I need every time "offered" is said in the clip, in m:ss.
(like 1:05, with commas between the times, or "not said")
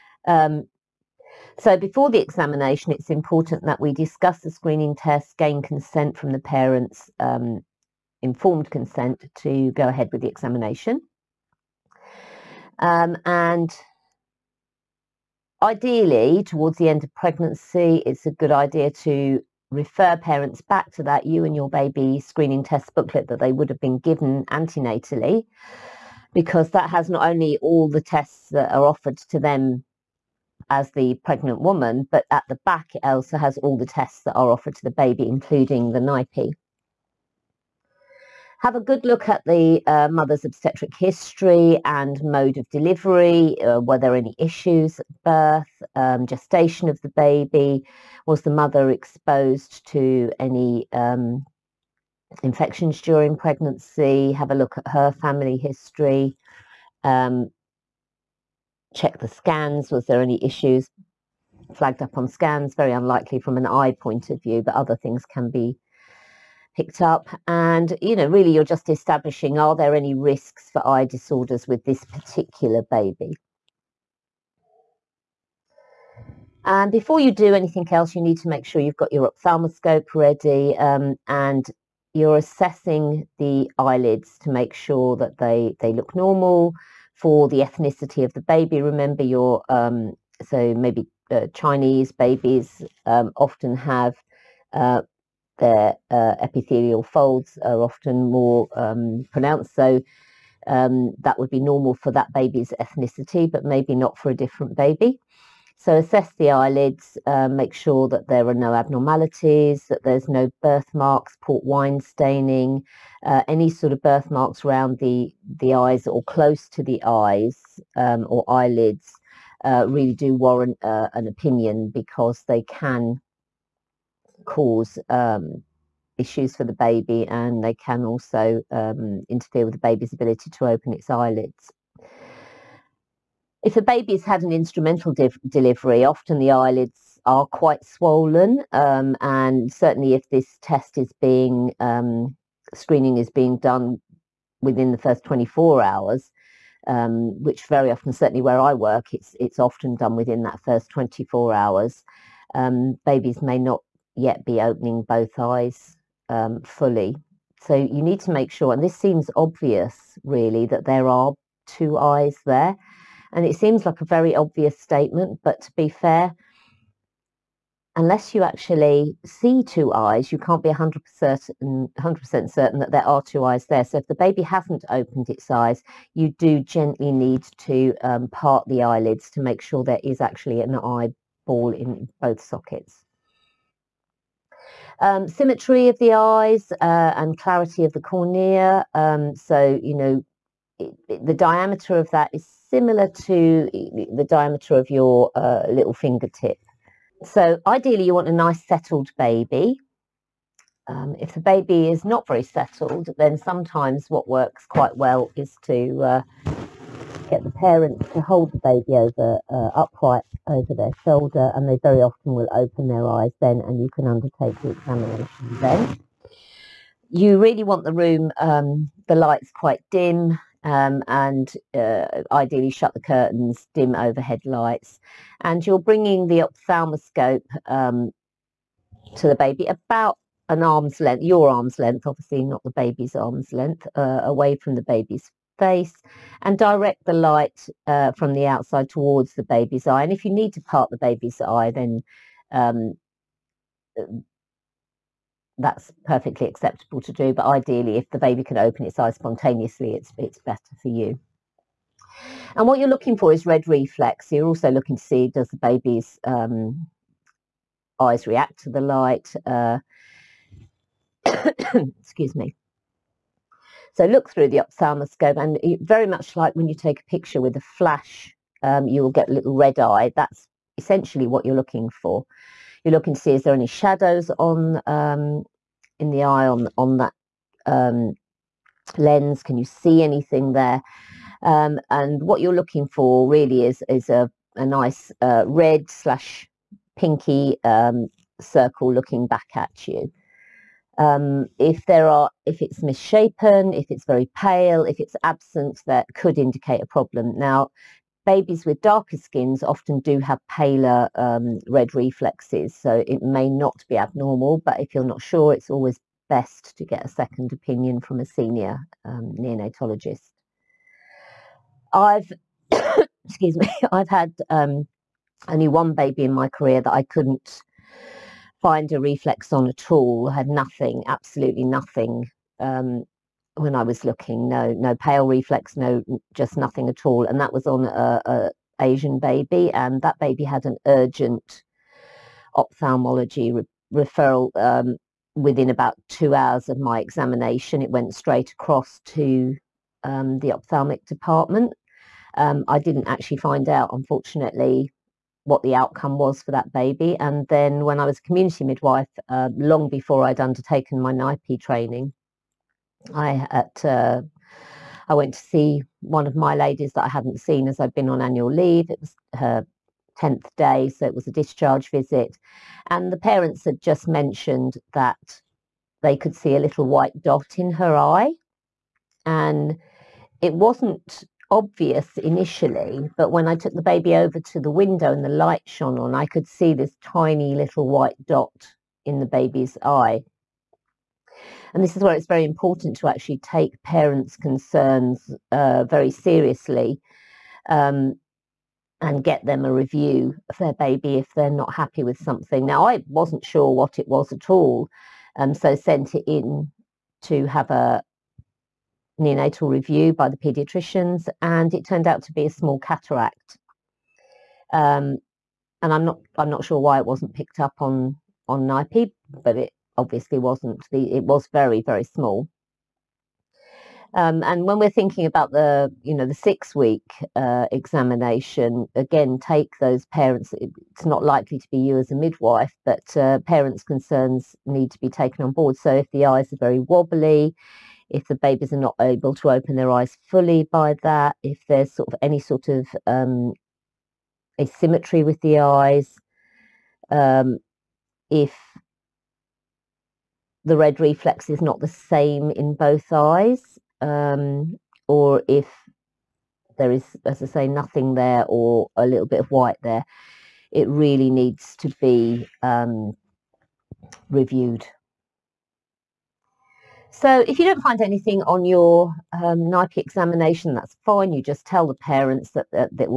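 0:28, 0:34.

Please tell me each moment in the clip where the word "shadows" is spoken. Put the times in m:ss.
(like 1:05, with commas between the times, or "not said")
4:33.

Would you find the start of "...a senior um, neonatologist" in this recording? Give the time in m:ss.
5:08.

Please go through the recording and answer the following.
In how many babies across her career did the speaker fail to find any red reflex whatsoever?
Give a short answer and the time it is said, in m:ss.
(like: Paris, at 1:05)
1, at 5:15.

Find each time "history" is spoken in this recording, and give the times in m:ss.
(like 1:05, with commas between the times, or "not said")
0:40, 0:55.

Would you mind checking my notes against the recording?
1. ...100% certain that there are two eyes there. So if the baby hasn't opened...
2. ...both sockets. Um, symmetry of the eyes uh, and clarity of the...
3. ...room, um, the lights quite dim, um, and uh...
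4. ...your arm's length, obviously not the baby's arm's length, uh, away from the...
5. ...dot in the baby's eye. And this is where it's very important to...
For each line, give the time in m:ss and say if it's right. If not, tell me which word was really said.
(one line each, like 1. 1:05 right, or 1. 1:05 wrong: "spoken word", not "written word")
1. 2:51 right
2. 3:02 right
3. 3:37 right
4. 3:51 right
5. 6:18 right.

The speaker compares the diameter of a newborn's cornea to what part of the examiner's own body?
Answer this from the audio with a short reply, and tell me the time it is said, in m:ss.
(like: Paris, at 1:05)
Little fingertip, at 3:15.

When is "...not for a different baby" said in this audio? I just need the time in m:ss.
1:43.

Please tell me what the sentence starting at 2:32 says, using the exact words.
Um, babies may not yet be opening both eyes um, fully.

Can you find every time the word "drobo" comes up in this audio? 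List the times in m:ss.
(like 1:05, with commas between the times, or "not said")
not said.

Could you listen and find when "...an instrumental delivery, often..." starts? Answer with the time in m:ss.
2:14.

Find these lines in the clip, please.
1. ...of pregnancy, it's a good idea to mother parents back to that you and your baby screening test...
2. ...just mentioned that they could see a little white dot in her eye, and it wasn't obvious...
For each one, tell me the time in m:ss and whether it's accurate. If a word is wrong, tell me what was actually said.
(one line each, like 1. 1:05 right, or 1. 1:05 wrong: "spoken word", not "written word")
1. 0:17 wrong: "refer", not "mother"
2. 6:03 right.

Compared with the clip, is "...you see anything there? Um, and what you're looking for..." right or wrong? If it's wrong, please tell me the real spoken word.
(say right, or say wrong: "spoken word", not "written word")
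right.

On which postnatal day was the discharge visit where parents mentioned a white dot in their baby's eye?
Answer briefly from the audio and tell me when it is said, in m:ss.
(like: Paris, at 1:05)
Tenth day, at 6:00.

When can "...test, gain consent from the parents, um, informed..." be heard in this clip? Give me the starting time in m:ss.
0:04.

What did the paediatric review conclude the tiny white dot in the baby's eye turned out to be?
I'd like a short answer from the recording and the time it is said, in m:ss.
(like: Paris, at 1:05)
Small cataract, at 6:42.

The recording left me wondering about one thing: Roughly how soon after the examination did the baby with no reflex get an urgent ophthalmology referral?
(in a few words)
About 2 hours.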